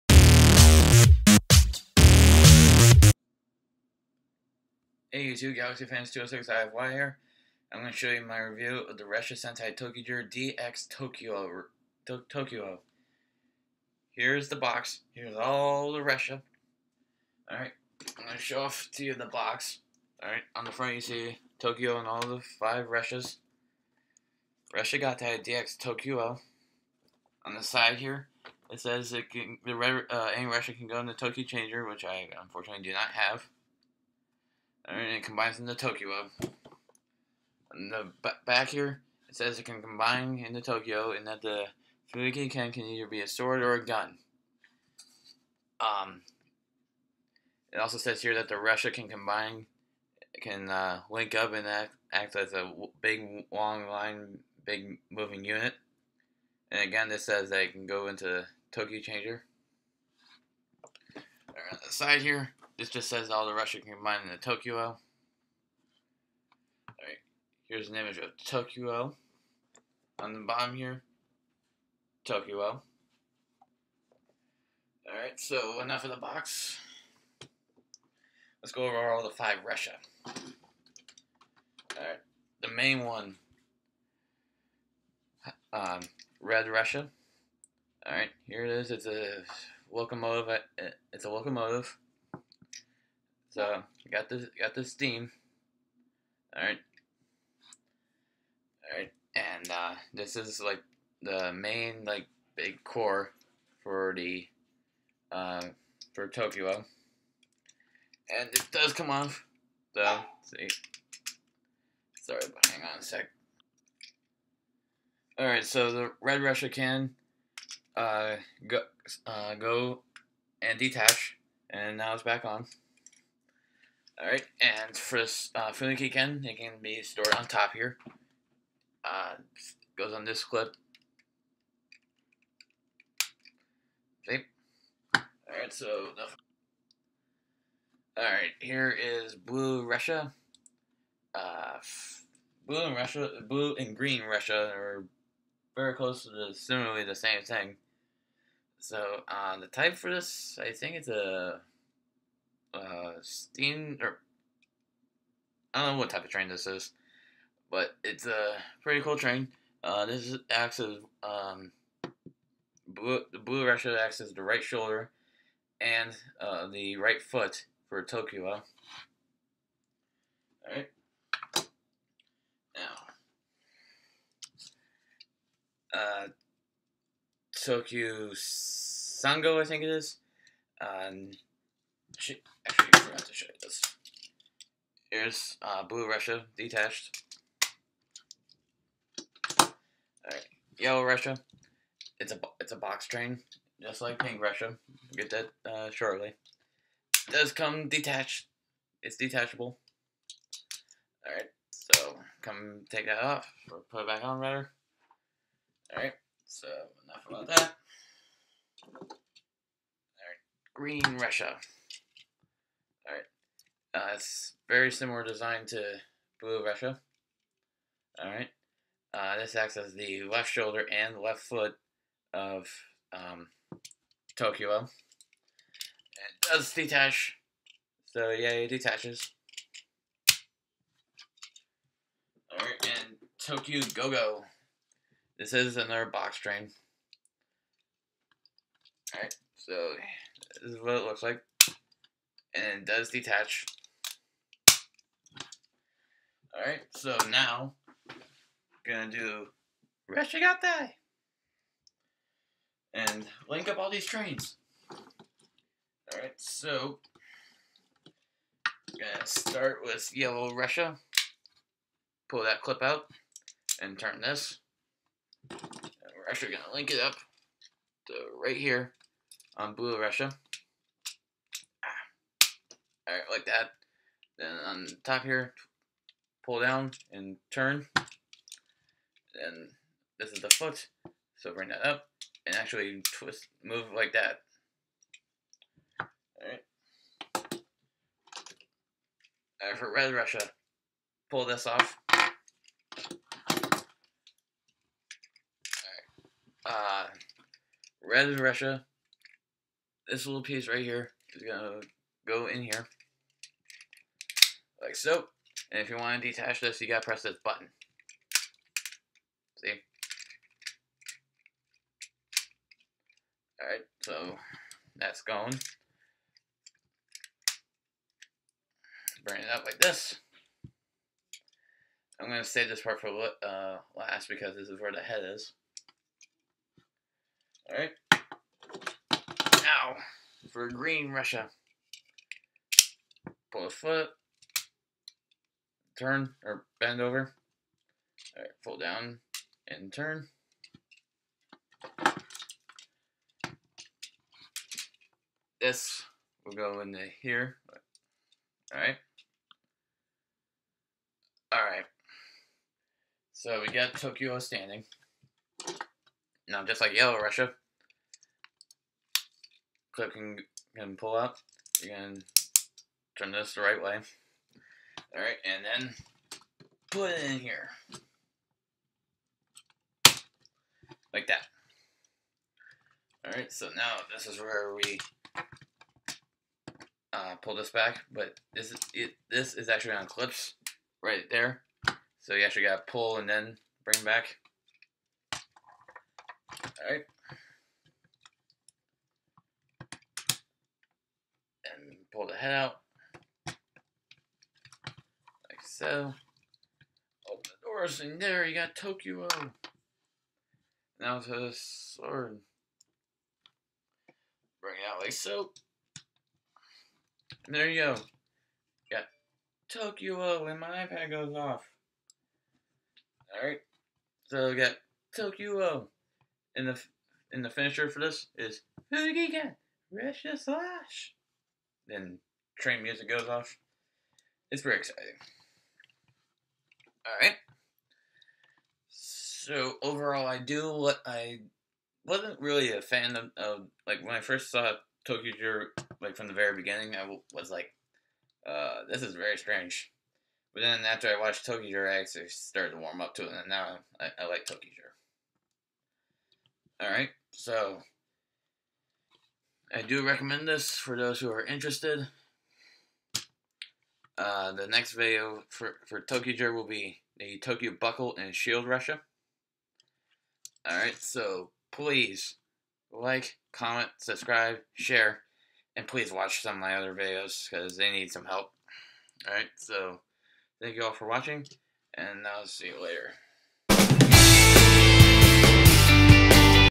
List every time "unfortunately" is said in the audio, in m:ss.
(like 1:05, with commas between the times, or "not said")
0:32.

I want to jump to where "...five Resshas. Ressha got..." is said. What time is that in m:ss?
0:22.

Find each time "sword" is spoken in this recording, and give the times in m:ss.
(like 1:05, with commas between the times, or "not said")
0:43, 6:41.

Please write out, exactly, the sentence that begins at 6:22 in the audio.
So you actually got to pull and then bring back.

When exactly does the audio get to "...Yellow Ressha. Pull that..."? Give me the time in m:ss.
4:20.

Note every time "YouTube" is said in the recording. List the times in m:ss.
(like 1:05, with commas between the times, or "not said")
0:05.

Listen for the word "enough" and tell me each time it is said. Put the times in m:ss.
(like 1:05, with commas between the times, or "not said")
1:15, 3:27.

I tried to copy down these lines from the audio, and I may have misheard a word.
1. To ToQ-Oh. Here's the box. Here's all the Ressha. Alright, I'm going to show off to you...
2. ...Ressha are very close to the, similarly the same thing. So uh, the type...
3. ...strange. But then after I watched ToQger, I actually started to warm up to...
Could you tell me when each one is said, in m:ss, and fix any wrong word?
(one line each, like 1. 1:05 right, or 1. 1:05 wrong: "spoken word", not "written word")
1. 0:12 right
2. 2:24 right
3. 7:19 right.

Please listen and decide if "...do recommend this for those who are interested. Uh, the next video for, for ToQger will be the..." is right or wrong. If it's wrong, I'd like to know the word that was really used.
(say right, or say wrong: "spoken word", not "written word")
right.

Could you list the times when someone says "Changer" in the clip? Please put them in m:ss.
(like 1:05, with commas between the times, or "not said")
0:31, 0:59.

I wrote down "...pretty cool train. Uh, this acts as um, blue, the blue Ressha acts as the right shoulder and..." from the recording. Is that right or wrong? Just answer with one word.
right.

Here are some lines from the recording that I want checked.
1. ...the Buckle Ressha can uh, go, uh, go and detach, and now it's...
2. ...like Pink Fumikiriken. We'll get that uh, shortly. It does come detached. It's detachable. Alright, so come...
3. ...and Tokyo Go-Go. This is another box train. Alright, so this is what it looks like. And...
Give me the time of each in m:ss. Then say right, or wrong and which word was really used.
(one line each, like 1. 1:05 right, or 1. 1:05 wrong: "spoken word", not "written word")
1. 1:55 wrong: "Red", not "Buckle"
2. 3:14 wrong: "Ressha", not "Fumikiriken"
3. 3:52 right.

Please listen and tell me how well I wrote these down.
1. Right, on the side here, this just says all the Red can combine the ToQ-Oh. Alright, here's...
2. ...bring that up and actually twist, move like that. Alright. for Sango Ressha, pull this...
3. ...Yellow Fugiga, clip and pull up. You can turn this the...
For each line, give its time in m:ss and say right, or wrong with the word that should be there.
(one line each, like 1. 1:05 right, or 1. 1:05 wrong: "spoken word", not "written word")
1. 1:01 wrong: "Ressha", not "Red"
2. 4:41 wrong: "Red", not "Sango"
3. 5:56 wrong: "Ressha", not "Fugiga".